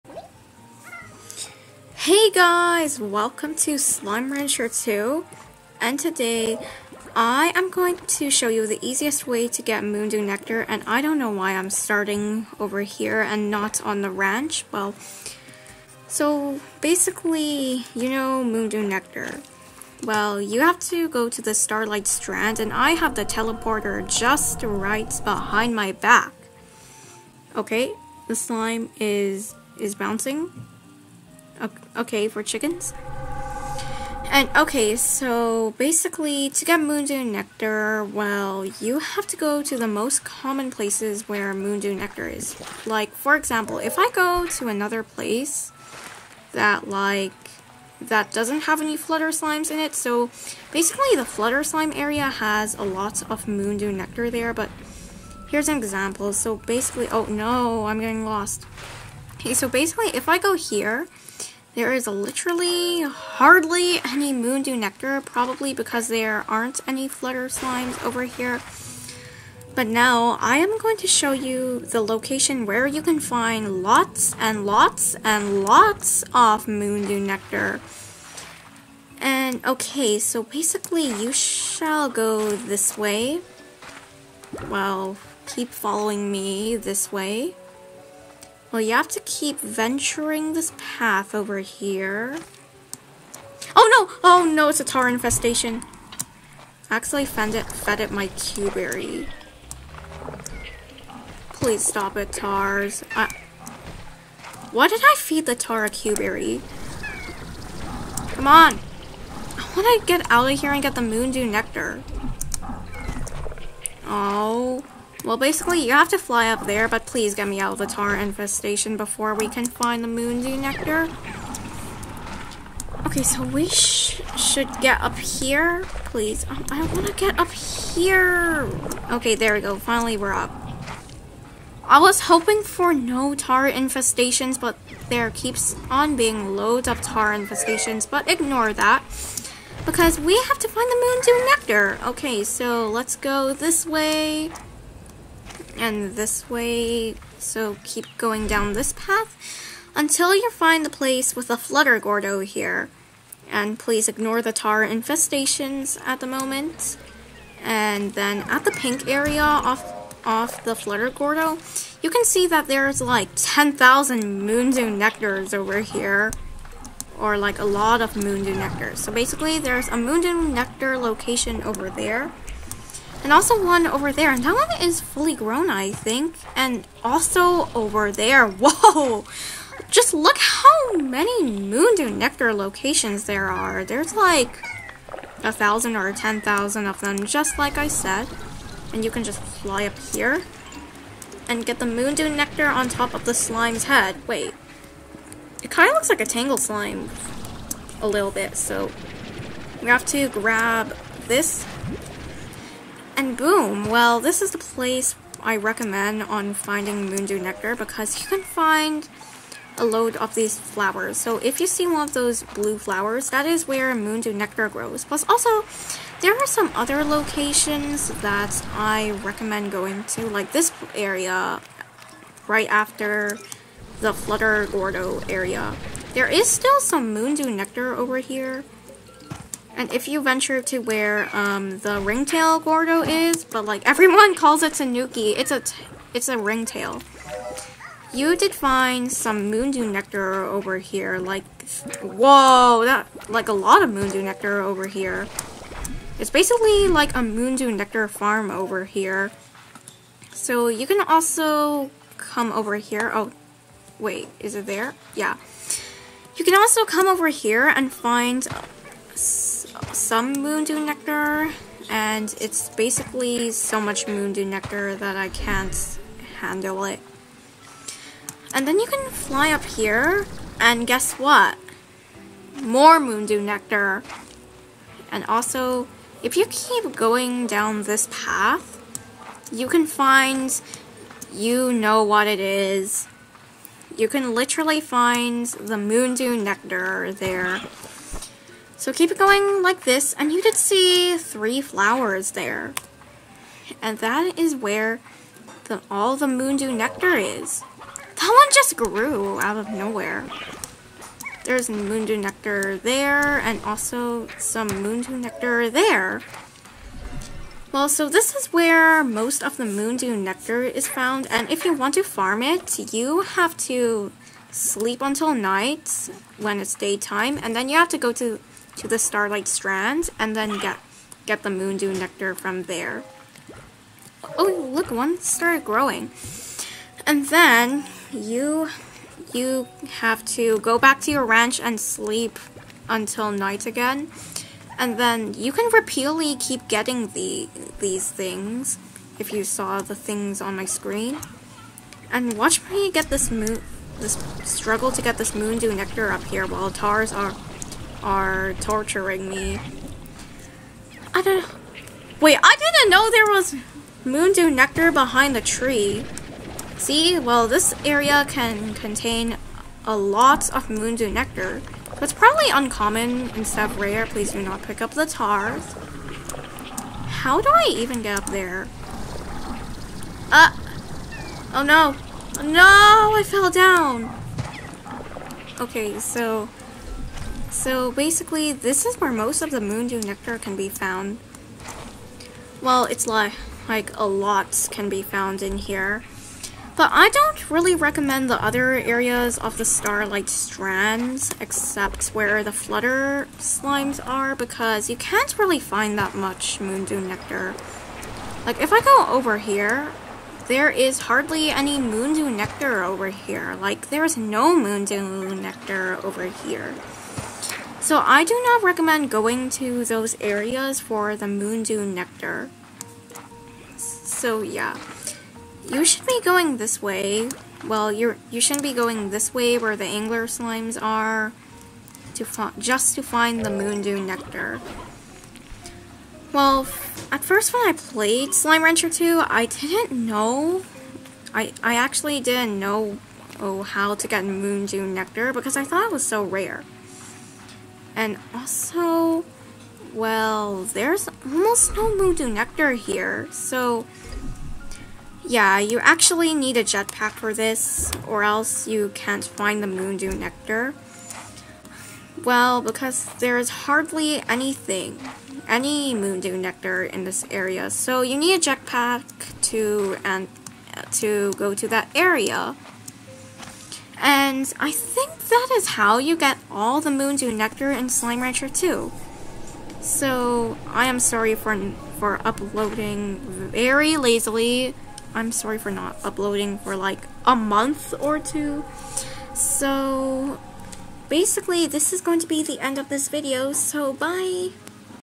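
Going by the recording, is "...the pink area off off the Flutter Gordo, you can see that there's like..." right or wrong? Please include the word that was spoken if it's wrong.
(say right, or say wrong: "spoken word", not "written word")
right.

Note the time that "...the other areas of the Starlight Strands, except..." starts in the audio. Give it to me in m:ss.
6:28.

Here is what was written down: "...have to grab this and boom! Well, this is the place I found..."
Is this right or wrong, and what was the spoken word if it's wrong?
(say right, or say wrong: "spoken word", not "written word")
wrong: "recommend", not "found".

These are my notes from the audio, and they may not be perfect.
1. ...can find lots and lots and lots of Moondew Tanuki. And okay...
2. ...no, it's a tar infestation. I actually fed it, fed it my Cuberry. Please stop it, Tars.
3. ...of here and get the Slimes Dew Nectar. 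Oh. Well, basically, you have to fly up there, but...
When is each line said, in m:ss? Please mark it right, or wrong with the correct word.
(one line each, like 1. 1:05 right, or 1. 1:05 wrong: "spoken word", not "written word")
1. 1:13 wrong: "Nectar", not "Tanuki"
2. 1:34 right
3. 1:50 wrong: "Moon", not "Slimes".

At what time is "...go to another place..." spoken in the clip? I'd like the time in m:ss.
0:44.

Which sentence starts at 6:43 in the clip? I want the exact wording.
Like, there is no moondew nectar over here.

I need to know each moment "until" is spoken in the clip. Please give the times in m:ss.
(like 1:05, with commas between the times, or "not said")
2:29, 5:15, 5:32.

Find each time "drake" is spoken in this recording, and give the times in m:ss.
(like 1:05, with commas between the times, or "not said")
not said.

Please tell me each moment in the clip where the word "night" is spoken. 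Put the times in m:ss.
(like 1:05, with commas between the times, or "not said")
5:15, 5:33.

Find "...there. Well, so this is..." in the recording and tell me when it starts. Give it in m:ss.
5:05.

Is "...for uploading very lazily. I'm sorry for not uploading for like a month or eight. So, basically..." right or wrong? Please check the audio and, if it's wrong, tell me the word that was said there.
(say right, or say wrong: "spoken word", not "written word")
wrong: "two", not "eight".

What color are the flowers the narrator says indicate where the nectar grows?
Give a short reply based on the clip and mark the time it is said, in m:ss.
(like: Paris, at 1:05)
Blue, at 3:32.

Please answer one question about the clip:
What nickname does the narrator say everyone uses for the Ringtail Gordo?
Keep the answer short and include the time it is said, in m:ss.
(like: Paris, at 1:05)
Tanuki, at 3:54.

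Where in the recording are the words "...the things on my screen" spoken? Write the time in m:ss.
5:39.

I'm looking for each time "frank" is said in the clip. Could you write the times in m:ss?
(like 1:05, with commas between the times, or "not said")
not said.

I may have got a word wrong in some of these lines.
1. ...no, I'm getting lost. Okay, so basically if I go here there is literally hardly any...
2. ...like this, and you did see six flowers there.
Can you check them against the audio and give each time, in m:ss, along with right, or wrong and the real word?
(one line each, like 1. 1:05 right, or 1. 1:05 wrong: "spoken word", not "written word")
1. 0:57 right
2. 4:49 wrong: "three", not "six".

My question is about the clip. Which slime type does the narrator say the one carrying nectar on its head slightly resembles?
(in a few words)
Tangled Slime.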